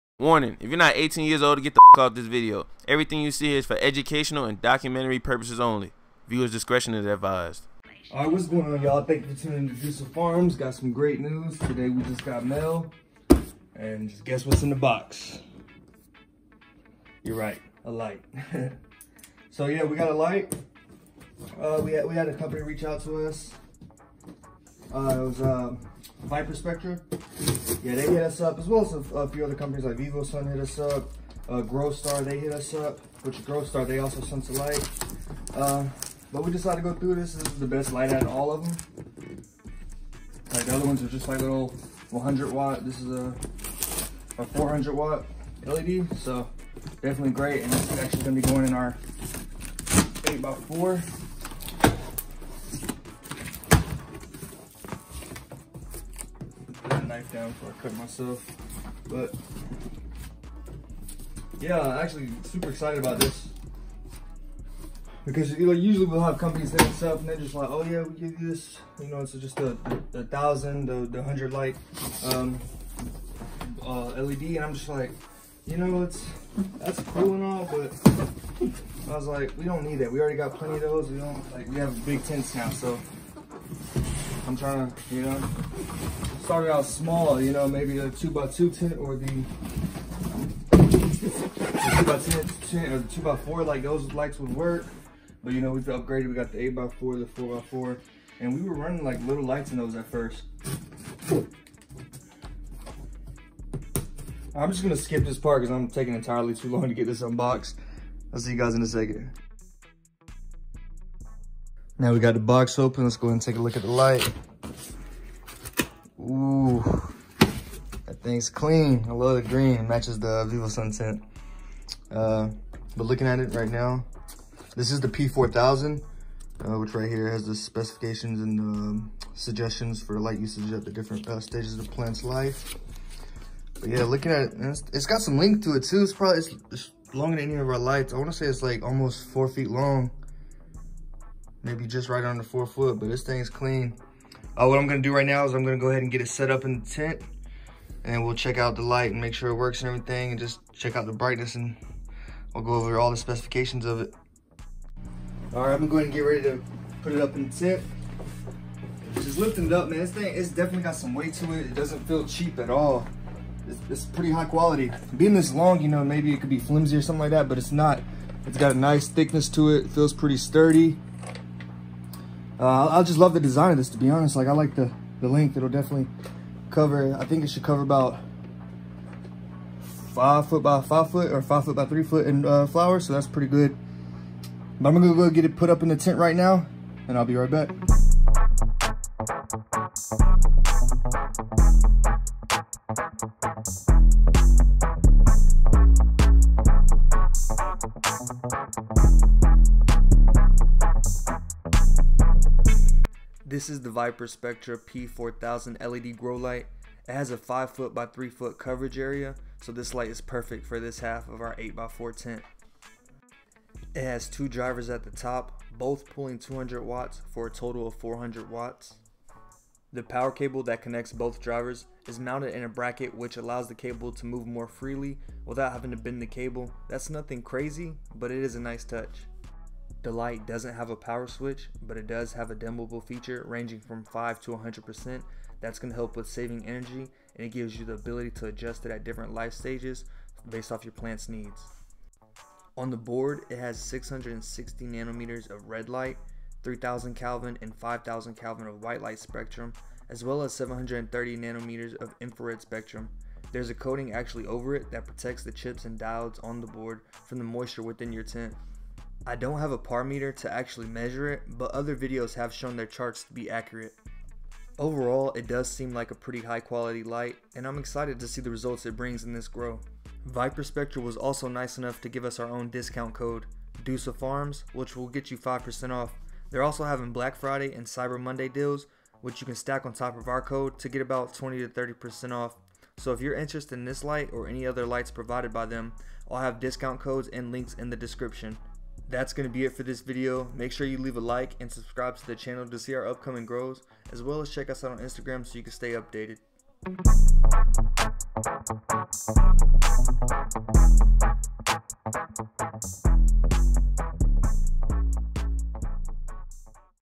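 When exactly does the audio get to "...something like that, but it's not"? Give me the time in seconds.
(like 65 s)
167 s.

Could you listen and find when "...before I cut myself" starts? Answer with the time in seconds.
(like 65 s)
57 s.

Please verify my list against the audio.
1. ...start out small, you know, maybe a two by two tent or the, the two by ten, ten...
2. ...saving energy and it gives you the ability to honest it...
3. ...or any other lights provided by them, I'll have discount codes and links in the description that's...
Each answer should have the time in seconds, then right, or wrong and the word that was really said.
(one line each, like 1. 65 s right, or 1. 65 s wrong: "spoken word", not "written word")
1. 86 s right
2. 236 s wrong: "adjust", not "honest"
3. 284 s right.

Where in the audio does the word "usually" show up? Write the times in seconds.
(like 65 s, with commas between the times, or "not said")
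65 s.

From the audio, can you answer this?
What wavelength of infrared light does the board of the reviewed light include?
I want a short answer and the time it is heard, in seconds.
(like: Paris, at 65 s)
730 nanometers, at 250 s.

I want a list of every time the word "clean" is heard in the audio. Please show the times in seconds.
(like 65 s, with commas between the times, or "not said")
118 s, 143 s.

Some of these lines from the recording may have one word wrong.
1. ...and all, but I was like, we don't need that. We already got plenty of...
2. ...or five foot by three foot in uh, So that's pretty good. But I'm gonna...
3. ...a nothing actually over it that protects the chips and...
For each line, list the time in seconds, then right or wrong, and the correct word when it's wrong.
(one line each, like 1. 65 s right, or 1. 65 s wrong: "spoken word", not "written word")
1. 77 s right
2. 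181 s right
3. 253 s wrong: "coating", not "nothing".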